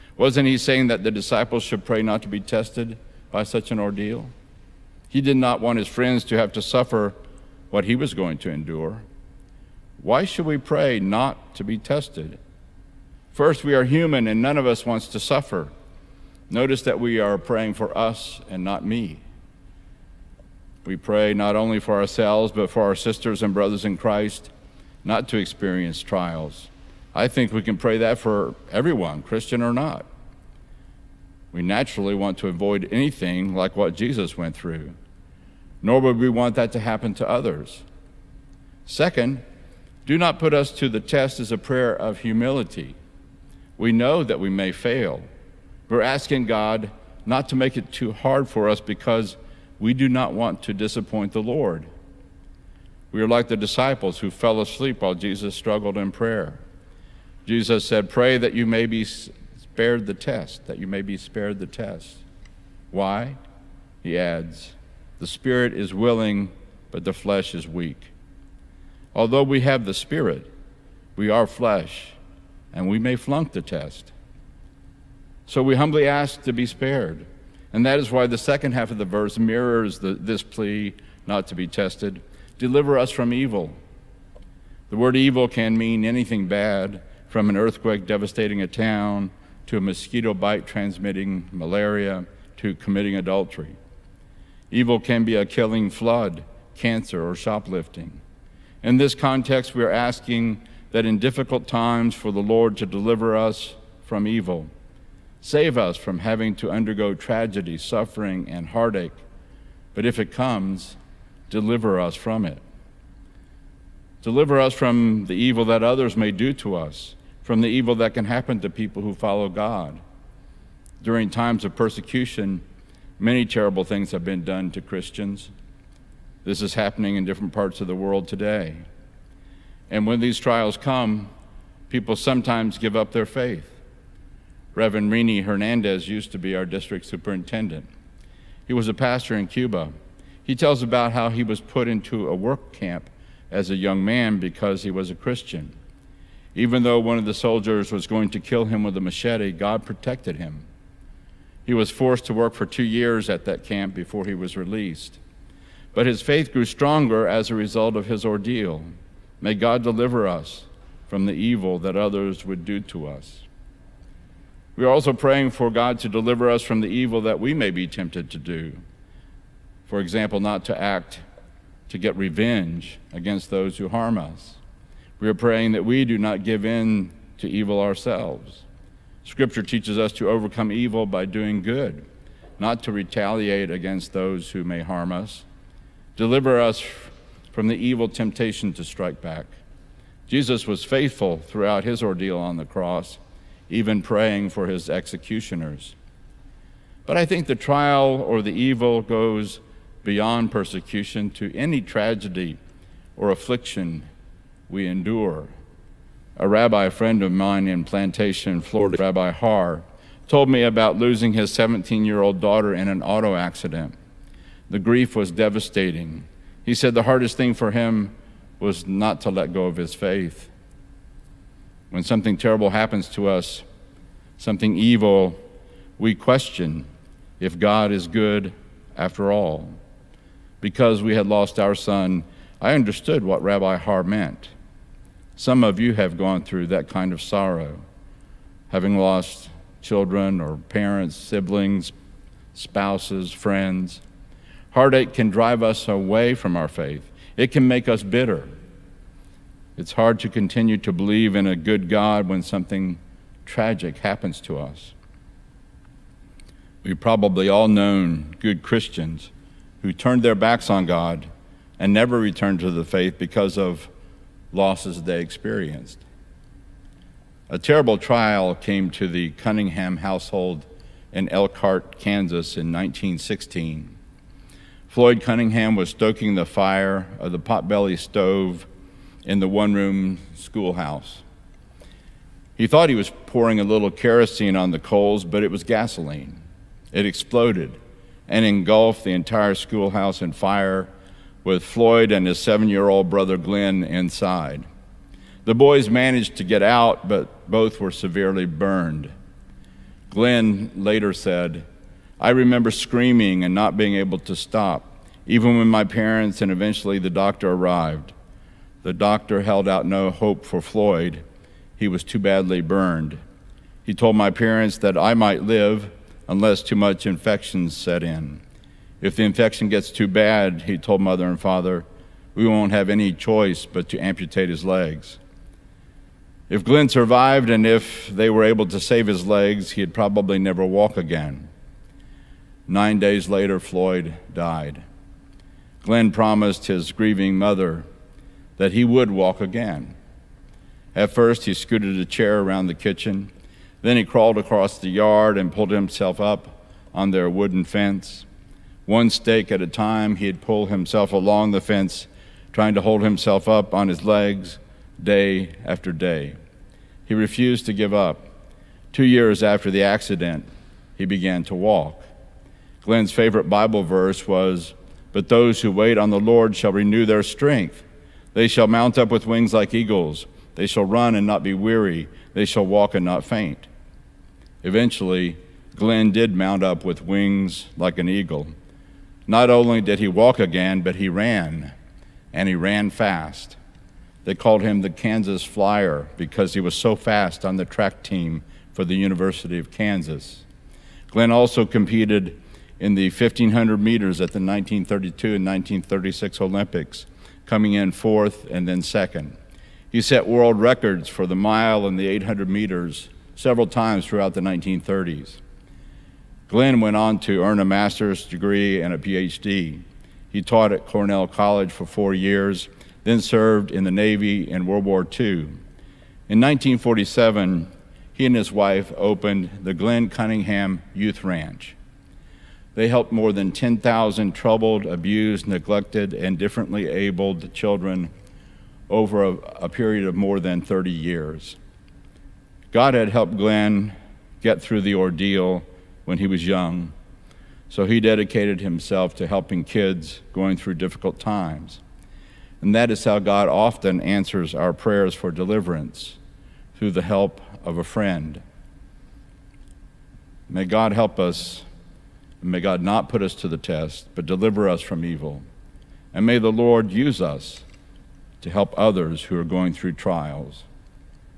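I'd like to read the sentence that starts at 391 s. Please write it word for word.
Glenn also competed in the 1500 meters at the 1932 and 1936 Olympics coming in fourth and then second.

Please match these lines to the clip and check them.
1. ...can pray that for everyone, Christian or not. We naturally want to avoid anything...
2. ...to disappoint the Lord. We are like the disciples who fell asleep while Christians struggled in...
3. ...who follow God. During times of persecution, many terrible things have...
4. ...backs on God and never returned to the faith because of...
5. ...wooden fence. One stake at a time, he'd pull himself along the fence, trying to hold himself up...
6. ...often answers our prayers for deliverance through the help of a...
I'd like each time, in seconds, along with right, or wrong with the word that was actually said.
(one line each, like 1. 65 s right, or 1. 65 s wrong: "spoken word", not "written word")
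1. 27 s right
2. 50 s wrong: "Jesus", not "Christians"
3. 119 s right
4. 260 s right
5. 347 s right
6. 443 s right.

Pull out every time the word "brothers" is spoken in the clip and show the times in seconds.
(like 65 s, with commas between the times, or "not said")
23 s, 293 s.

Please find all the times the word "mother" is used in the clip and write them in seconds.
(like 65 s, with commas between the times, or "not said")
321 s, 337 s.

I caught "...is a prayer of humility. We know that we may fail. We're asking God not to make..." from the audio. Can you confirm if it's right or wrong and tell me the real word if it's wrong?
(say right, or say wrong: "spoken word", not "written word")
right.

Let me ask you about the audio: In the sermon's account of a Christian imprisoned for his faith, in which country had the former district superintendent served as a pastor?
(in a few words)
Cuba.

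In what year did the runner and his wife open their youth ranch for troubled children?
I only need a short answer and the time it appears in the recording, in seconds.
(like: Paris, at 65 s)
1947, at 416 s.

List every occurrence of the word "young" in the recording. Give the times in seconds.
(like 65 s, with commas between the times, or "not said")
143 s, 436 s.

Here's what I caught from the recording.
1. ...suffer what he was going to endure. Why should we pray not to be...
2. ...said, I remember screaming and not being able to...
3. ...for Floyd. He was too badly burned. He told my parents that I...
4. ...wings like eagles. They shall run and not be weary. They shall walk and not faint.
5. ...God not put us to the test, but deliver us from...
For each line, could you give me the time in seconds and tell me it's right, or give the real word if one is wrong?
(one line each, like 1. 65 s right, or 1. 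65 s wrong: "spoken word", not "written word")
1. 6 s right
2. 301 s right
3. 310 s right
4. 369 s right
5. 452 s right.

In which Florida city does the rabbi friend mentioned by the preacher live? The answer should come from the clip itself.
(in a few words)
Plantation.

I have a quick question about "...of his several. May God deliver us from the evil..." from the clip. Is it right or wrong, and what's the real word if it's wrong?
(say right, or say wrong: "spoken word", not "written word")
wrong: "ordeal", not "several".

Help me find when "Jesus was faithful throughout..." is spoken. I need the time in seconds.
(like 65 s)
190 s.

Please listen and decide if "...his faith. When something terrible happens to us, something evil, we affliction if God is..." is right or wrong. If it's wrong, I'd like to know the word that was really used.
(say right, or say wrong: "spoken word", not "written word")
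wrong: "question", not "affliction".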